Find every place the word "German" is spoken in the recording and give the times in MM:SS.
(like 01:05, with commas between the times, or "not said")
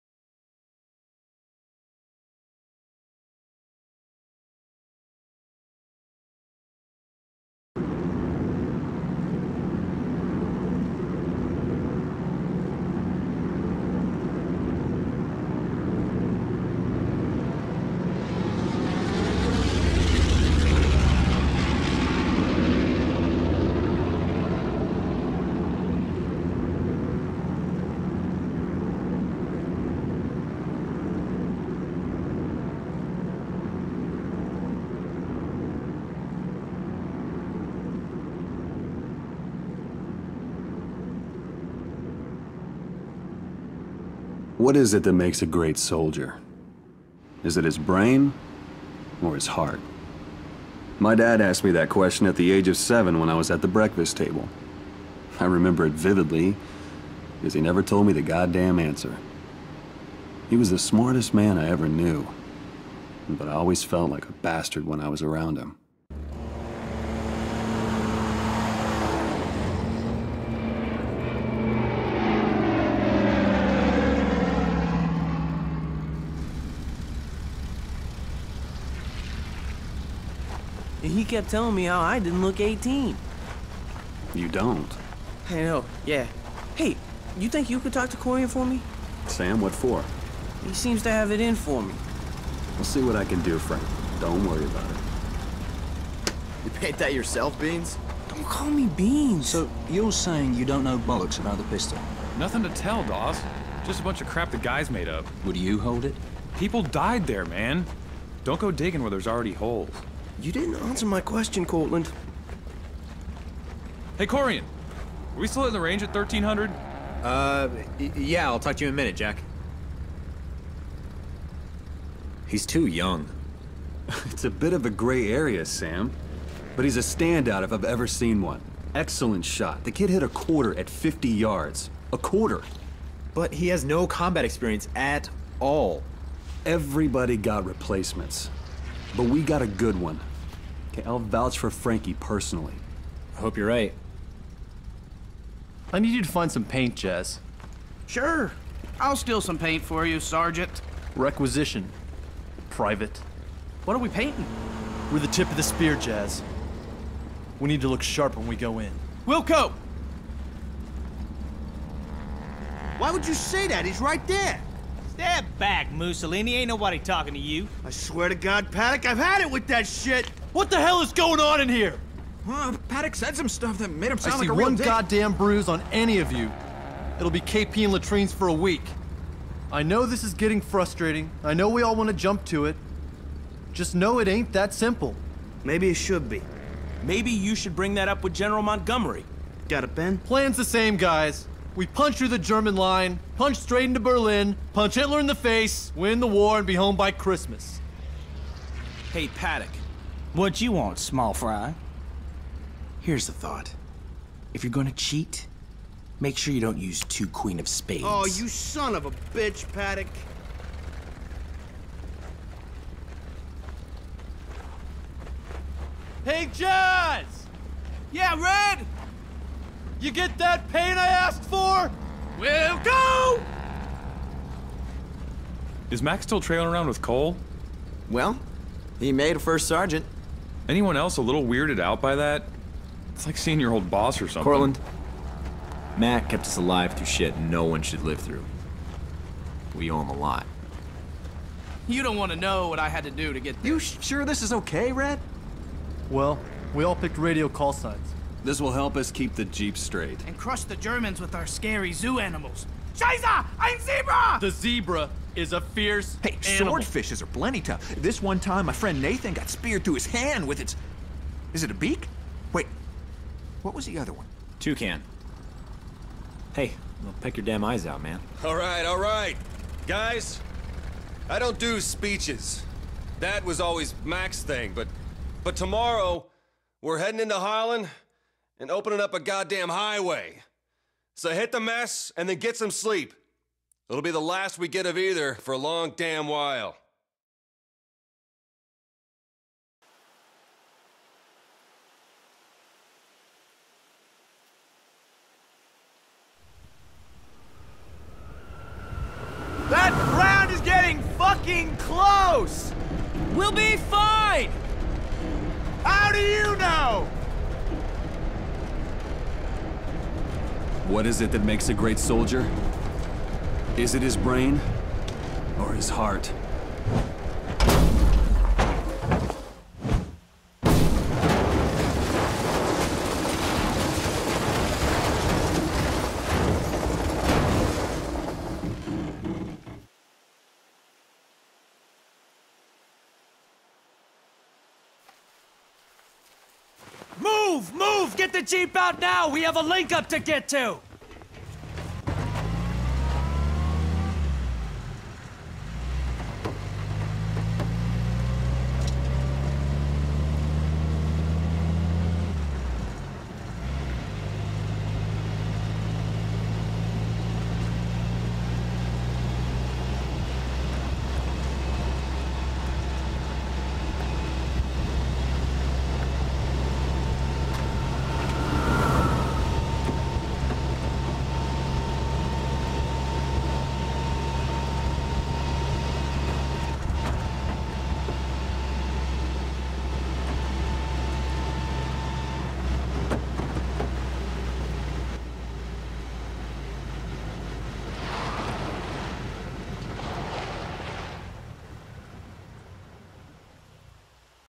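03:12, 04:10.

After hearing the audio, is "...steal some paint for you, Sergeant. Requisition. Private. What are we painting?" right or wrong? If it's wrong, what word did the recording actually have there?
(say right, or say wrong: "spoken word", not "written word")
right.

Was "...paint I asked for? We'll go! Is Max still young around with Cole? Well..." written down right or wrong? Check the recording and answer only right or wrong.
wrong.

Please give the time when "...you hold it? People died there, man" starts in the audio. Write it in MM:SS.
01:45.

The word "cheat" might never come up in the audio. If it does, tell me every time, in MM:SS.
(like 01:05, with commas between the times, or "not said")
03:24.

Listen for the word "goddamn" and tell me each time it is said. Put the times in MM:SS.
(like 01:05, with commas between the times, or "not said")
00:58, 02:54, 04:39.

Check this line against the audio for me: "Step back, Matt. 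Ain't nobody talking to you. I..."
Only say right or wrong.
wrong.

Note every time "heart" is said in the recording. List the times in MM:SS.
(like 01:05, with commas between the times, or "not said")
00:49, 05:15.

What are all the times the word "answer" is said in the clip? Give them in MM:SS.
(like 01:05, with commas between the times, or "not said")
00:58, 01:50.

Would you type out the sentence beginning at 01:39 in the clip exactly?
So, you're saying you don't know bollocks about the pistol?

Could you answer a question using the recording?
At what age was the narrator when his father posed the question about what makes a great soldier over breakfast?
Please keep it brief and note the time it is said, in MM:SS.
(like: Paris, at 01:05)
7, at 00:52.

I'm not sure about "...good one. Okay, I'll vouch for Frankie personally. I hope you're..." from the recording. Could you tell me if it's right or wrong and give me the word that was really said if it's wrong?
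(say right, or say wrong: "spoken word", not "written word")
right.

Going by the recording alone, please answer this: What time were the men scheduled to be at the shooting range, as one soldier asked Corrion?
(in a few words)
1300.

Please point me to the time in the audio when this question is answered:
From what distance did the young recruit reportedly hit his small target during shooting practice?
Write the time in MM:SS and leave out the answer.
02:10.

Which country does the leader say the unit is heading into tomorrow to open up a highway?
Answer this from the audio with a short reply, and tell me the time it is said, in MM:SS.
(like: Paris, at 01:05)
Holland, at 04:37.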